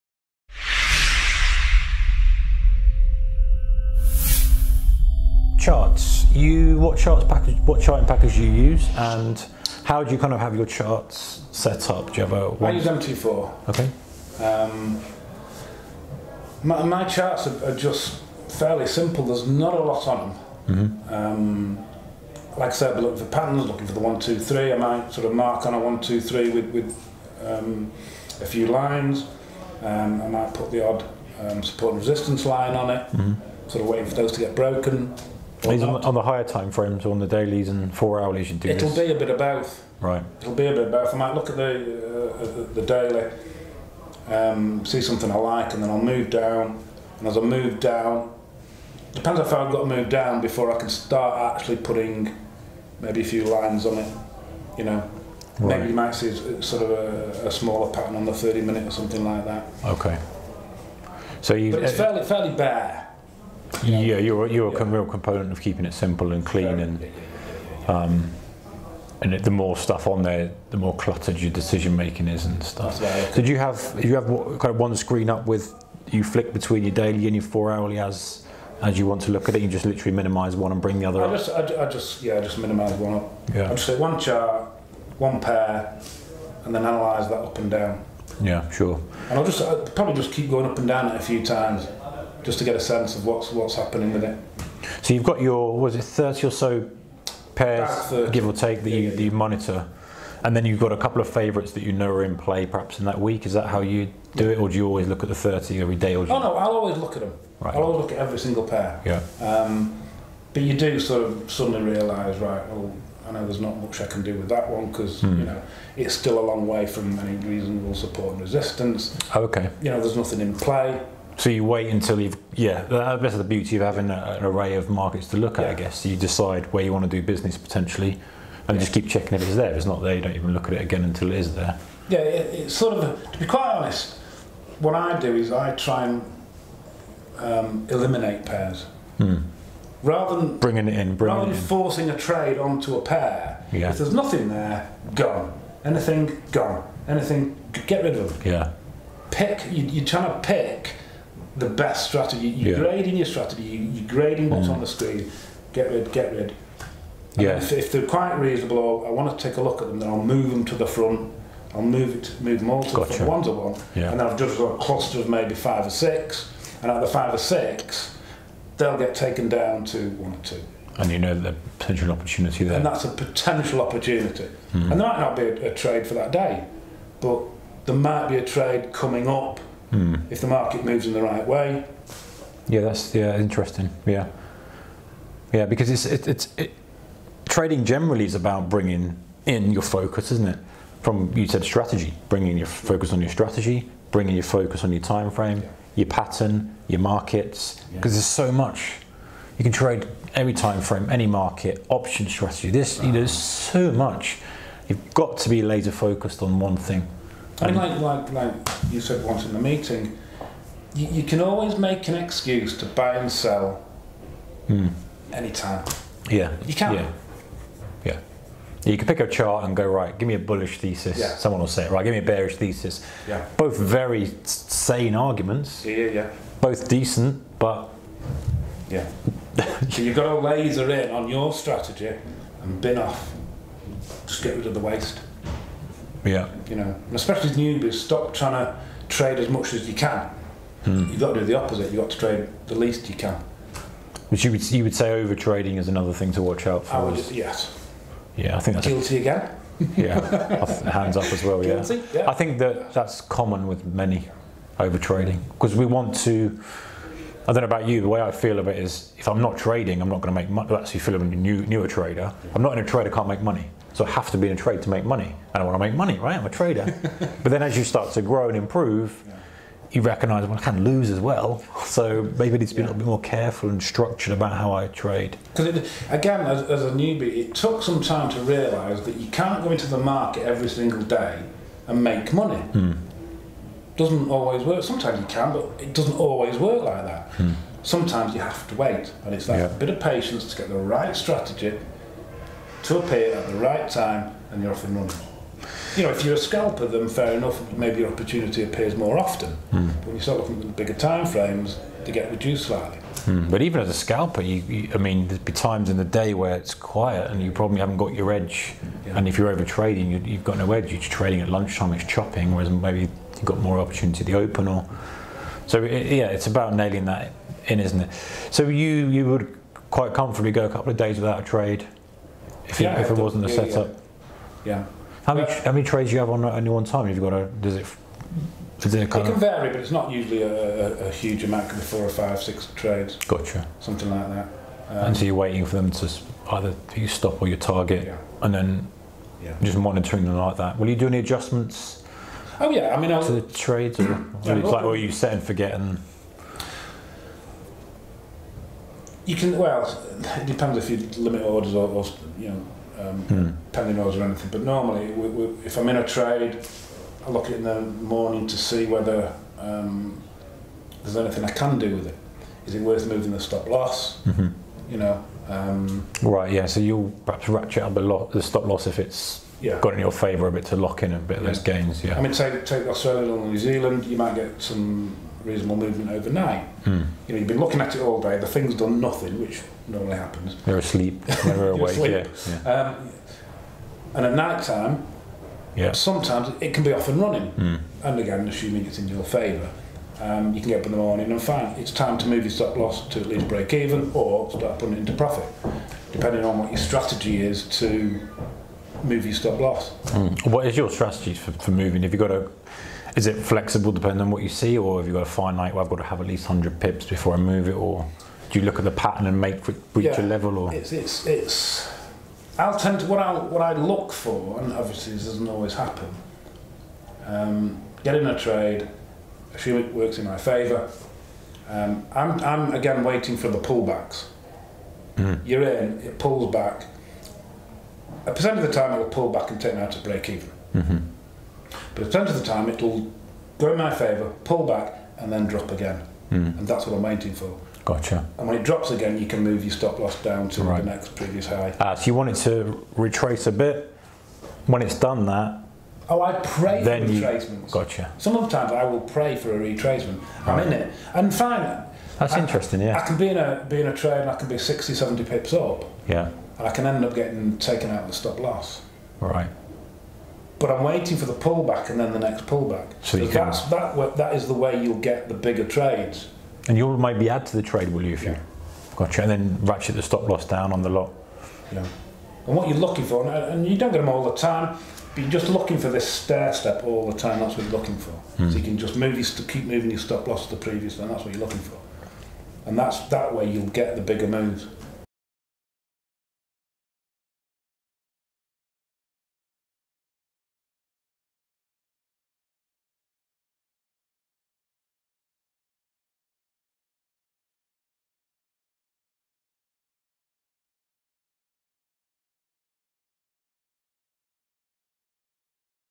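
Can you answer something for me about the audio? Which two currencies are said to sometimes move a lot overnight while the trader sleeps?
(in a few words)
Australia or New Zealand.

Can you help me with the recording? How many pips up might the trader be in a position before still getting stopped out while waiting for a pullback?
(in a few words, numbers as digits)
60 or 70.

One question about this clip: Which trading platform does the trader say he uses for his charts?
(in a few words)
MT4.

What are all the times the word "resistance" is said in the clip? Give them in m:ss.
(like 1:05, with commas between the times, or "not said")
0:32, 1:58.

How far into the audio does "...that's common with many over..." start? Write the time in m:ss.
4:12.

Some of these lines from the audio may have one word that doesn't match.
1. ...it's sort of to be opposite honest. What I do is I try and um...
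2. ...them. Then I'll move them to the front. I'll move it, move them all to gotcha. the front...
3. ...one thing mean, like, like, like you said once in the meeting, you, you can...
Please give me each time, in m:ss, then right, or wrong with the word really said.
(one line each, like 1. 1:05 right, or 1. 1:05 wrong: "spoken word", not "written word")
1. 2:12 wrong: "quite", not "opposite"
2. 2:39 right
3. 3:26 right.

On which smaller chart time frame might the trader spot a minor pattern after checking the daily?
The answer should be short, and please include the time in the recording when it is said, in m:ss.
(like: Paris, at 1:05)
30 minute, at 0:58.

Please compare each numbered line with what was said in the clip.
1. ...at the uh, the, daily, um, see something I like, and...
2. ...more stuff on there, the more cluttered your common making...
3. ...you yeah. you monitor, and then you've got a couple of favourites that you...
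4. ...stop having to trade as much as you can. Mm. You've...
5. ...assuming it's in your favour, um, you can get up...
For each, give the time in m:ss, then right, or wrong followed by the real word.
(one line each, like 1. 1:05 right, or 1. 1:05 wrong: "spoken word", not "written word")
1. 0:41 right
2. 1:09 wrong: "decision", not "common"
3. 1:38 right
4. 3:57 wrong: "trying", not "having"
5. 6:28 right.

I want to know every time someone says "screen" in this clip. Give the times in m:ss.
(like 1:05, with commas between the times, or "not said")
1:14, 2:34.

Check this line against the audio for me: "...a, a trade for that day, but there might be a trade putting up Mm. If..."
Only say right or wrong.
wrong.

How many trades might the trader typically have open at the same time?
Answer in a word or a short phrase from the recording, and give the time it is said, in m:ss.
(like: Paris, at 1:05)
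4, 5 or 6, at 5:31.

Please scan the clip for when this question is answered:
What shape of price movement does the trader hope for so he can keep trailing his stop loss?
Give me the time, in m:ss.
7:56.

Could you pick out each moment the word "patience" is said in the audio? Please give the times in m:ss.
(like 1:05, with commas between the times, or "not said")
4:49.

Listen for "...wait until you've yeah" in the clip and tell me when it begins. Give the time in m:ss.
2:01.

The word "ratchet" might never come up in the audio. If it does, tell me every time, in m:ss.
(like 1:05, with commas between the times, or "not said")
6:07, 7:49.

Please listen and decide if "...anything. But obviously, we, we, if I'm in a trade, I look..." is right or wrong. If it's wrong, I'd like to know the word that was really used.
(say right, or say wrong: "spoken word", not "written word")
wrong: "normally", not "obviously".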